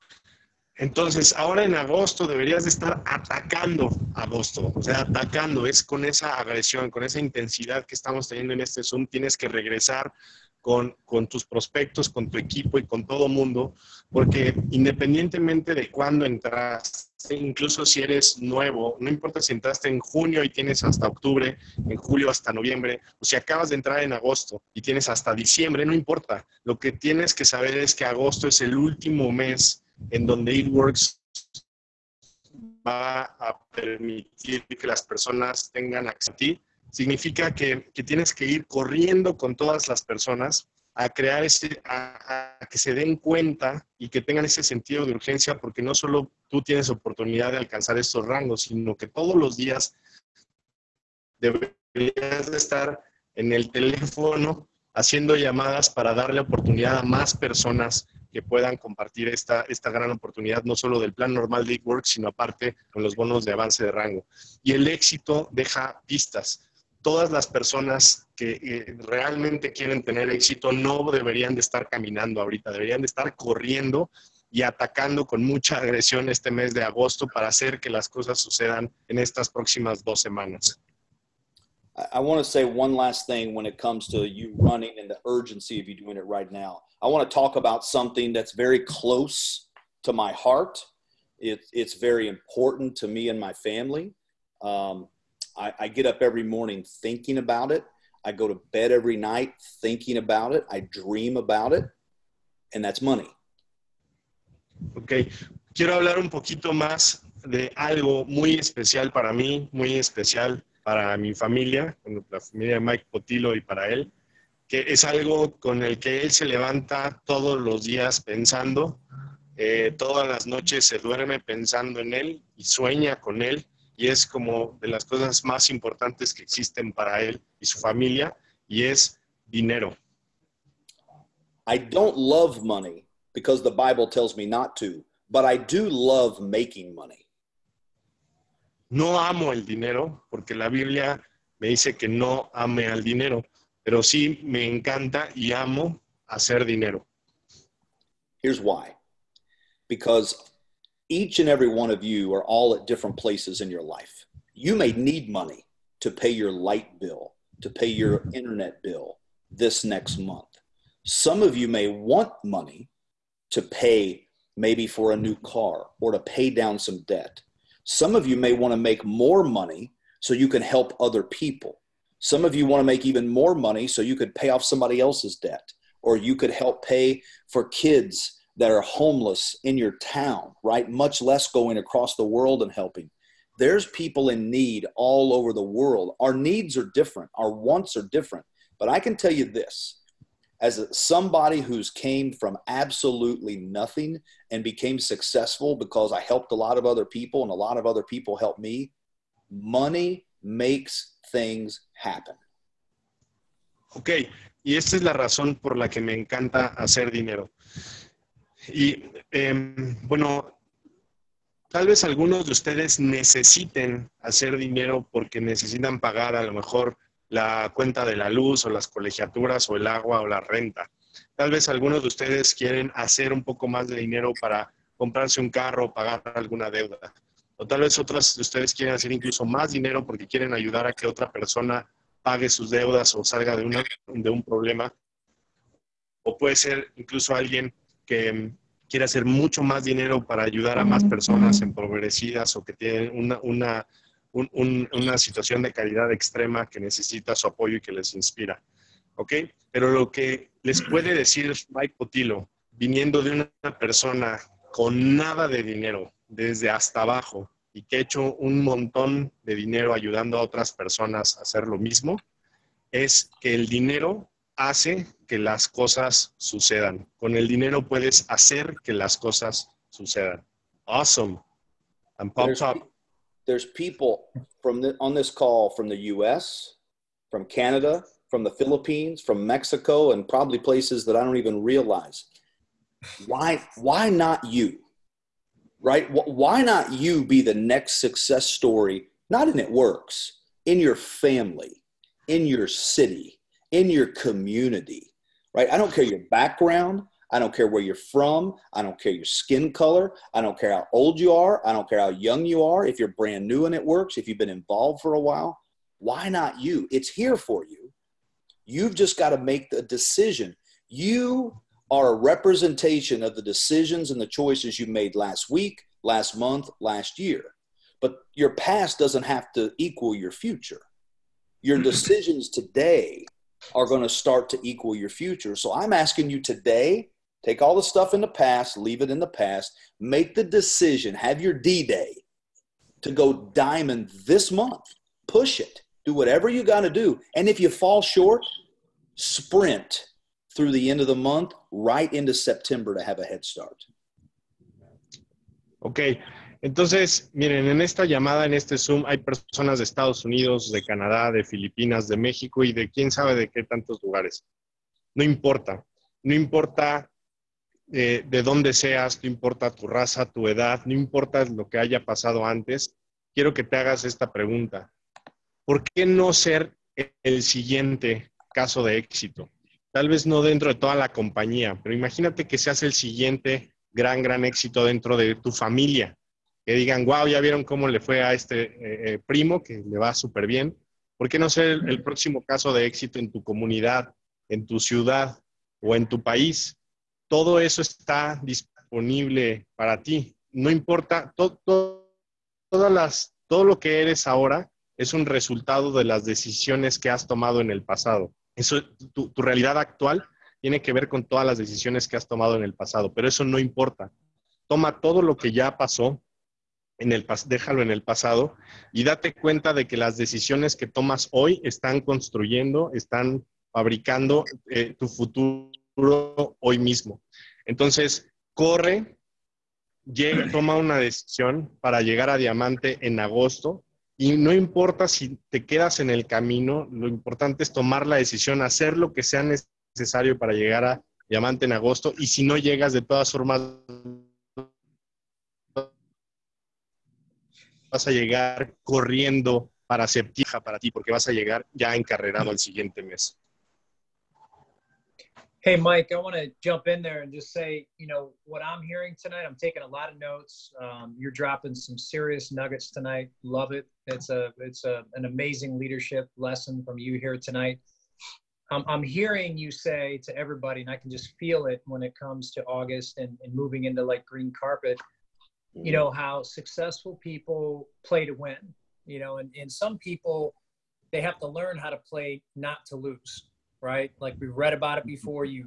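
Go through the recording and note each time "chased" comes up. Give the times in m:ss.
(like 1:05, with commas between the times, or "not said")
not said.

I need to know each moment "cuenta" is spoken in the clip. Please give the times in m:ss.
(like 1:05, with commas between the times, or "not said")
0:43, 3:37, 6:49.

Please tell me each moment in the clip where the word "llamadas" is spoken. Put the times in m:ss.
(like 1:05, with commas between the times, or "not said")
0:55, 5:48.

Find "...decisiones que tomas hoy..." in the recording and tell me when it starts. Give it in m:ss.
6:50.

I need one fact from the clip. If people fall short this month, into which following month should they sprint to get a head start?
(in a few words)
September.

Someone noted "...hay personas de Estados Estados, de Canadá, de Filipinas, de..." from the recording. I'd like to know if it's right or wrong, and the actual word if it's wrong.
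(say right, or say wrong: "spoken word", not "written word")
wrong: "Unidos", not "Estados".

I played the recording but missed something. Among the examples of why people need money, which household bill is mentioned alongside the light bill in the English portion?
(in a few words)
internet bill.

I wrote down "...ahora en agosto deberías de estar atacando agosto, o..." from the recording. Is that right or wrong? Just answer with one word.
right.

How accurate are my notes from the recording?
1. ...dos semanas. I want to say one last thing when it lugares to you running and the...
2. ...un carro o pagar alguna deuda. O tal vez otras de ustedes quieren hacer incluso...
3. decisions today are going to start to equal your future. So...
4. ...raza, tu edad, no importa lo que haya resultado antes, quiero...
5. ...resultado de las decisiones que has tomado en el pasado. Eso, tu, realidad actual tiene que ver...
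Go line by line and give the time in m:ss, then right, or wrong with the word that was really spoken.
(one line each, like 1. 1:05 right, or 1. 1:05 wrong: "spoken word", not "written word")
1. 1:20 wrong: "comes", not "lugares"
2. 3:45 right
3. 5:21 right
4. 5:59 wrong: "pasado", not "resultado"
5. 6:35 right.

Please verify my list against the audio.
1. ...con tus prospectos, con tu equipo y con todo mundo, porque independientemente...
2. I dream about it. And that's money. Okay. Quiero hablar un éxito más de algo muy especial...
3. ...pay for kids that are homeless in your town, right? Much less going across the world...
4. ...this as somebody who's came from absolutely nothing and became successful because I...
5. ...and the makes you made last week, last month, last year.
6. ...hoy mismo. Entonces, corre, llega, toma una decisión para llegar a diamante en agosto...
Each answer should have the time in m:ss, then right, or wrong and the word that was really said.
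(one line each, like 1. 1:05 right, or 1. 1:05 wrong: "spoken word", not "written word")
1. 0:11 right
2. 1:40 wrong: "poquito", not "éxito"
3. 2:56 right
4. 3:09 right
5. 5:14 wrong: "choices", not "makes"
6. 6:56 right.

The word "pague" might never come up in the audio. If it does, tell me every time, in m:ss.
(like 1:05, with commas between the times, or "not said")
3:52.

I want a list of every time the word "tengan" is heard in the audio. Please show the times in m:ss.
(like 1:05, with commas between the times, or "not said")
0:35, 0:44.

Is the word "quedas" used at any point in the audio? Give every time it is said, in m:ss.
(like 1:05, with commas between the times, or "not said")
7:05.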